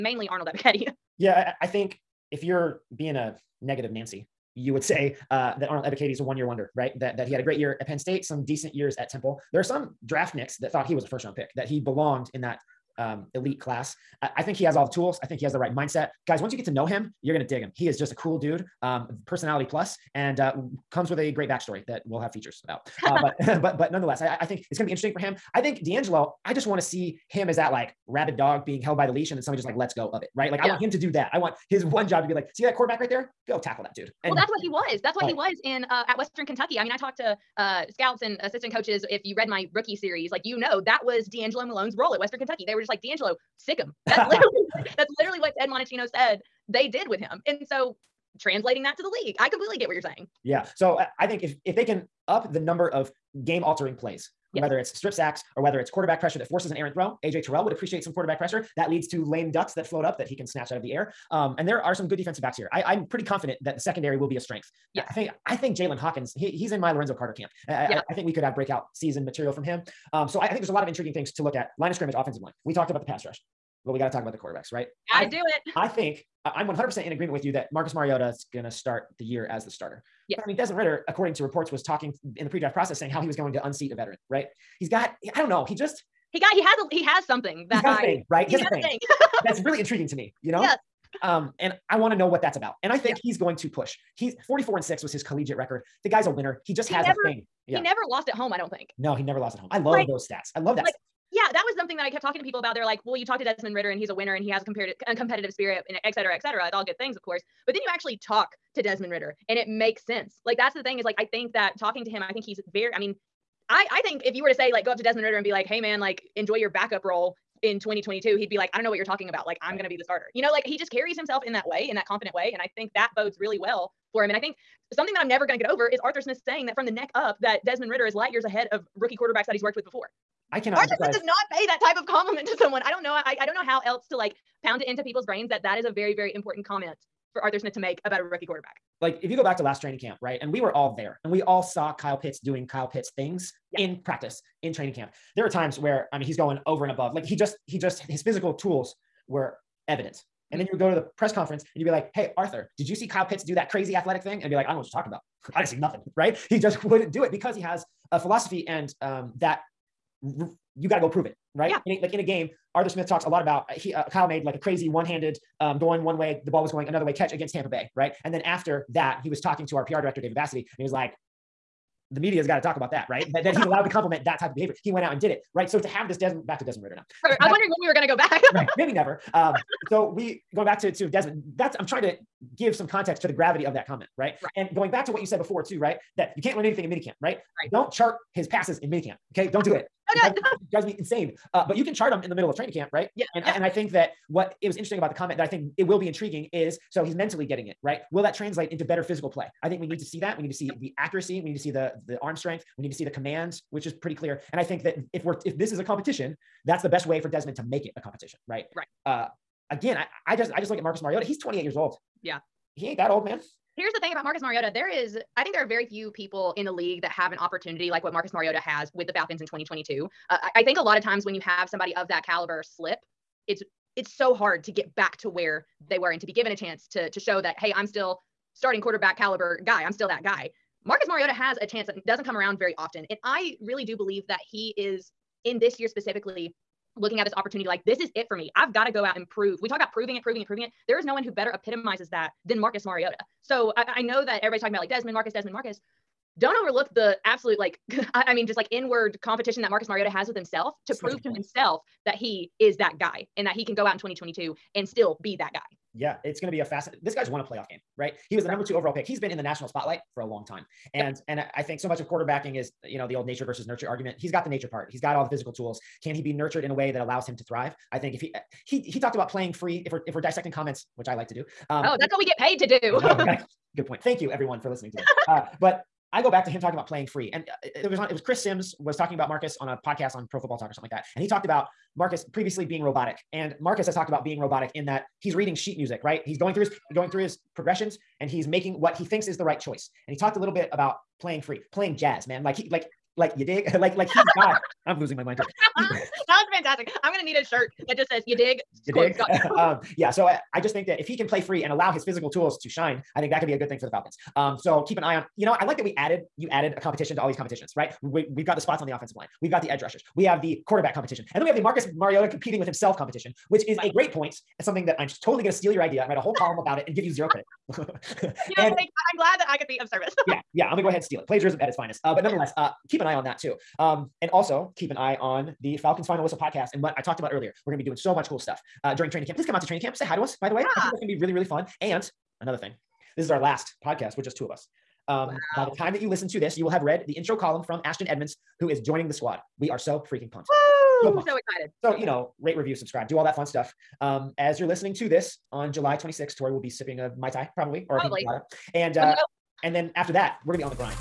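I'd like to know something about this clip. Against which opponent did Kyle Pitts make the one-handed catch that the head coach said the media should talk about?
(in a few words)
Tampa Bay.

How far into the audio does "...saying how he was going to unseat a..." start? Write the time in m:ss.
1:22.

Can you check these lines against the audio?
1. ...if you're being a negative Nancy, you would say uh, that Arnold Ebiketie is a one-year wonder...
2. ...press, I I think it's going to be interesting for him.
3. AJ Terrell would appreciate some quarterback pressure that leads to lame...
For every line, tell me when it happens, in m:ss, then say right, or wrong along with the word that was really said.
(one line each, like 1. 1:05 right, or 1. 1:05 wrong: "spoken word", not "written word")
1. 0:02 right
2. 0:23 wrong: "nonetheless", not "press"
3. 0:57 right.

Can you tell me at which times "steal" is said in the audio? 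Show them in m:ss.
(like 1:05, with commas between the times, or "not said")
5:15, 5:21.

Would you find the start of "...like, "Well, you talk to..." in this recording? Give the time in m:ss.
1:42.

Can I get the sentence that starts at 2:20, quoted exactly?
And we were all there and we all saw Kyle Pitts doing Kyle Pitts things yeah.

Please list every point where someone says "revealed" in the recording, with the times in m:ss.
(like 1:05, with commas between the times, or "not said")
not said.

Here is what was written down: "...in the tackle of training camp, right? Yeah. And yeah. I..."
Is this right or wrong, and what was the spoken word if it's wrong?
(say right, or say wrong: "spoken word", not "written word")
wrong: "middle", not "tackle".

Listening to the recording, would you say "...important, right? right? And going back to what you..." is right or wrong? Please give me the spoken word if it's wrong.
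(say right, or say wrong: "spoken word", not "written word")
wrong: "comment", not "important".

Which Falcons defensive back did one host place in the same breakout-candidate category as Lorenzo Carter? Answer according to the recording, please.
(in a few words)
Jaylinn Hawkins.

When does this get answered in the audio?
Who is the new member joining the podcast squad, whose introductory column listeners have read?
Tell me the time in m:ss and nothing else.
5:37.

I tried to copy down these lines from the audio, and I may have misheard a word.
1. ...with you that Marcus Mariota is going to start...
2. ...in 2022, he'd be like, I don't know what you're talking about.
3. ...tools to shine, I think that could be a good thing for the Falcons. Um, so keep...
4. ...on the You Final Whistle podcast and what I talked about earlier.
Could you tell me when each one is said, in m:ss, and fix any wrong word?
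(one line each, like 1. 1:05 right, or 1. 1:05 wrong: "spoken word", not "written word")
1. 1:17 right
2. 1:57 right
3. 5:02 right
4. 5:25 wrong: "Falcons", not "You".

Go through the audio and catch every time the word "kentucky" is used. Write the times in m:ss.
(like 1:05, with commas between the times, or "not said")
0:36, 0:42.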